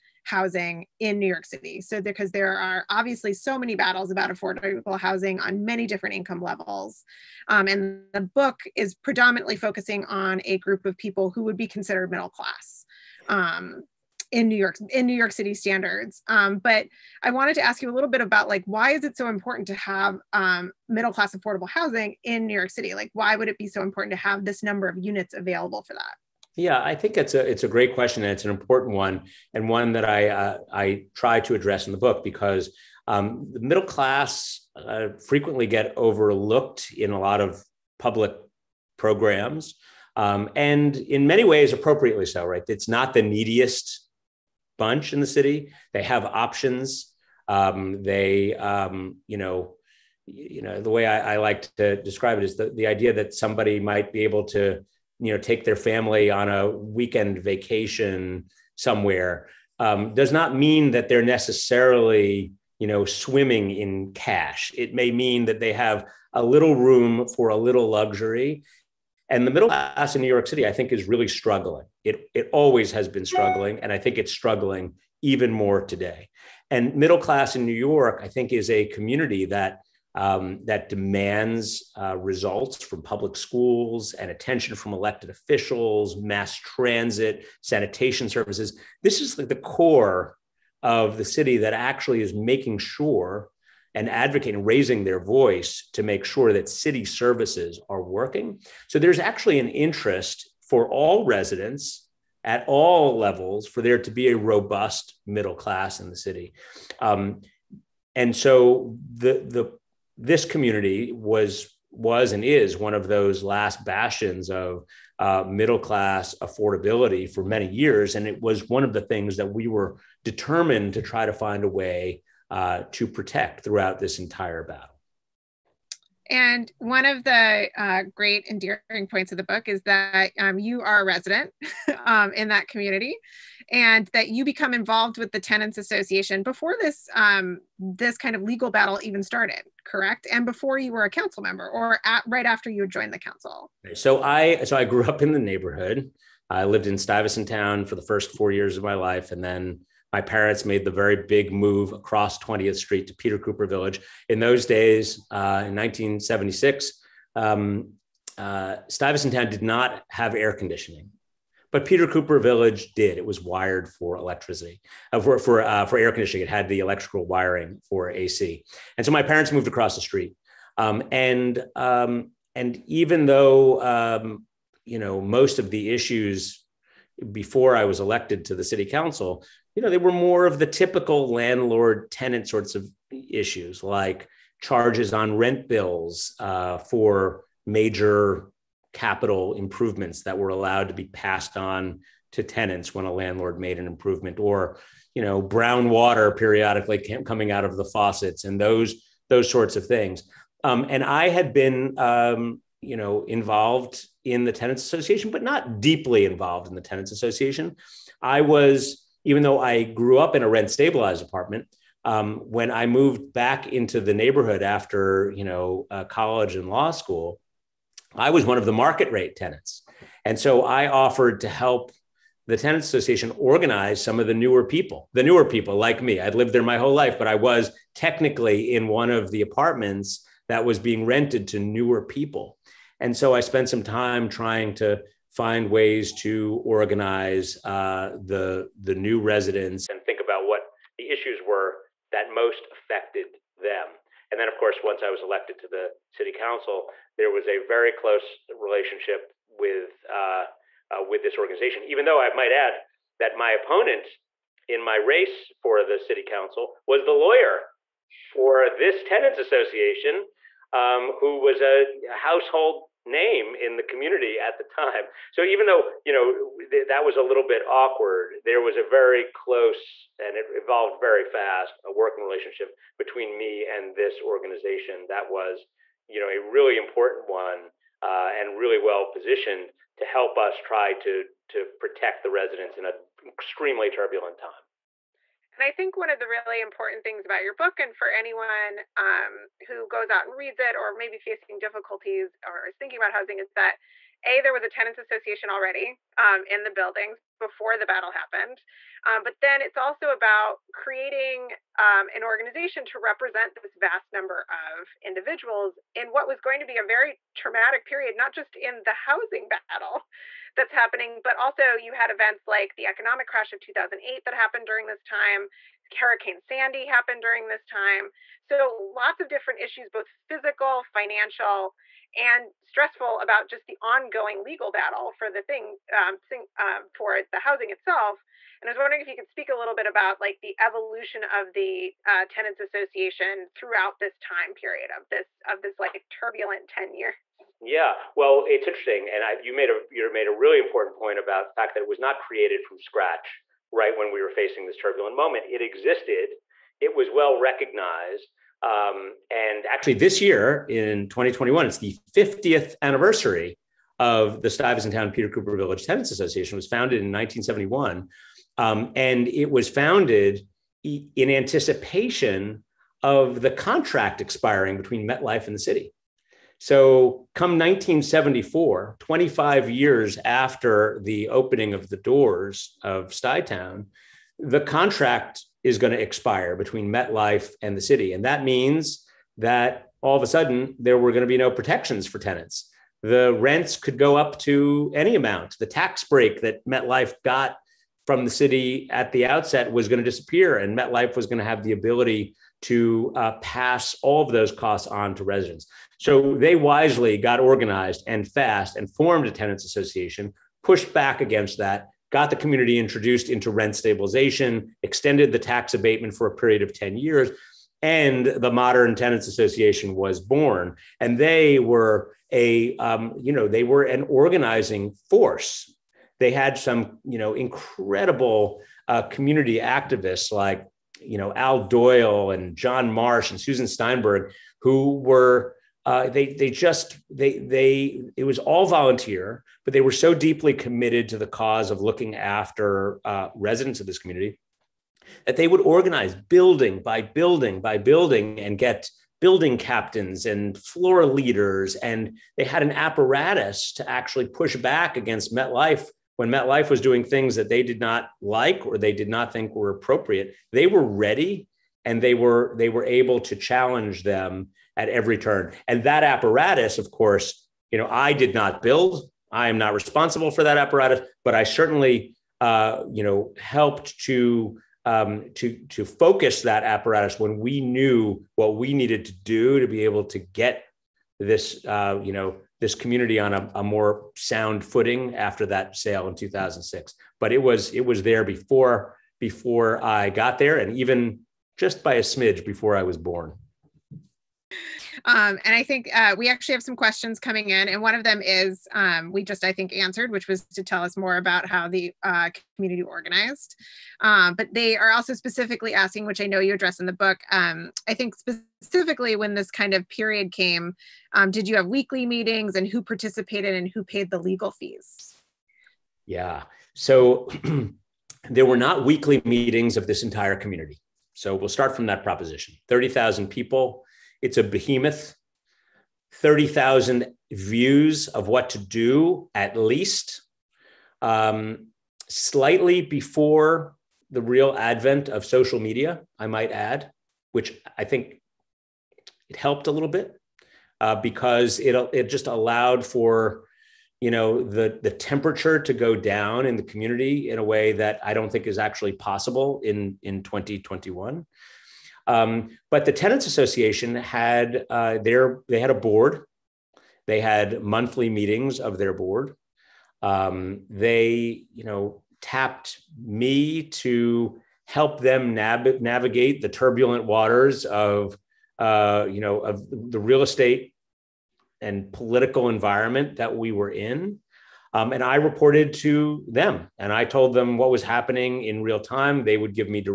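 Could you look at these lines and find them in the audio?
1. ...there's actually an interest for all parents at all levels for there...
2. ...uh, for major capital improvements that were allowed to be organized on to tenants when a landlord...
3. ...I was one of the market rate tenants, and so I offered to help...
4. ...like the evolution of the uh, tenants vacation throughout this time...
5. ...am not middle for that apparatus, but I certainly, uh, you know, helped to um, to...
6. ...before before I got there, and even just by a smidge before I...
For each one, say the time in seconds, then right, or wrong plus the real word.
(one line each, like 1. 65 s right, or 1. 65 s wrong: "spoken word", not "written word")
1. 98 s wrong: "residents", not "parents"
2. 186 s wrong: "passed", not "organized"
3. 218 s right
4. 330 s wrong: "association", not "vacation"
5. 459 s wrong: "responsible", not "middle"
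6. 478 s right.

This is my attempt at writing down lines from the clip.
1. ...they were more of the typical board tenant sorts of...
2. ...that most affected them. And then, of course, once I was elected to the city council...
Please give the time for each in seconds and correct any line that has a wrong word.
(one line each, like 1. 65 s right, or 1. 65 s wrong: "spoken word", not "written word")
1. 179 s wrong: "landlord", not "board"
2. 242 s right.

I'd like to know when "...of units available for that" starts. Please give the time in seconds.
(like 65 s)
24 s.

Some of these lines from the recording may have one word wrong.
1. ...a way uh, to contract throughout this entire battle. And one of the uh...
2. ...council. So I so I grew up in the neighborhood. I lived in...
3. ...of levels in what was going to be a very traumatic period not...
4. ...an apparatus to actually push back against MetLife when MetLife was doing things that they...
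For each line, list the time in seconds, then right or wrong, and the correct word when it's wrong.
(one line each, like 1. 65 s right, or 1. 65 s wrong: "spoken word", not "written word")
1. 121 s wrong: "protect", not "contract"
2. 143 s right
3. 304 s wrong: "individuals", not "levels"
4. 442 s right.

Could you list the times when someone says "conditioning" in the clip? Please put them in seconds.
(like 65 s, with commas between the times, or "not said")
160 s, 166 s.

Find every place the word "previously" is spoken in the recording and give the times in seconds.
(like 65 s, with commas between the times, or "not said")
not said.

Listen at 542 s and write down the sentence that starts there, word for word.
Um, but the tenants association had uh, their they had a board.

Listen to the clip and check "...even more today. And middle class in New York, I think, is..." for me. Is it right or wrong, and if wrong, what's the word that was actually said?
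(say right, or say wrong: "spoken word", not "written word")
right.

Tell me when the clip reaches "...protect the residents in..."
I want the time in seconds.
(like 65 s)
281 s.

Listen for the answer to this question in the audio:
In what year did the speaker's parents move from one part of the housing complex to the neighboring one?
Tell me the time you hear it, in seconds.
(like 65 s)
155 s.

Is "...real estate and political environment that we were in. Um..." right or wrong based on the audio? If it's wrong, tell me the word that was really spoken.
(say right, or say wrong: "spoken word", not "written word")
right.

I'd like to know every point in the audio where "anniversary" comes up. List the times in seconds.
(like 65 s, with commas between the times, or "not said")
352 s.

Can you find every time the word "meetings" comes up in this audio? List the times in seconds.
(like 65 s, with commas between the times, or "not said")
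502 s, 509 s, 548 s.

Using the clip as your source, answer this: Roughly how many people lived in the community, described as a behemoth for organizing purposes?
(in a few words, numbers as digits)
30,000.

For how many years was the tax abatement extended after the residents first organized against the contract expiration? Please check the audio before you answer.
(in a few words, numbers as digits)
10.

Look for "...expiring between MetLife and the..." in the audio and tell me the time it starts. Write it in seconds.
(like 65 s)
364 s.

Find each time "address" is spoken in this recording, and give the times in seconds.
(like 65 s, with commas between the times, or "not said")
31 s, 496 s.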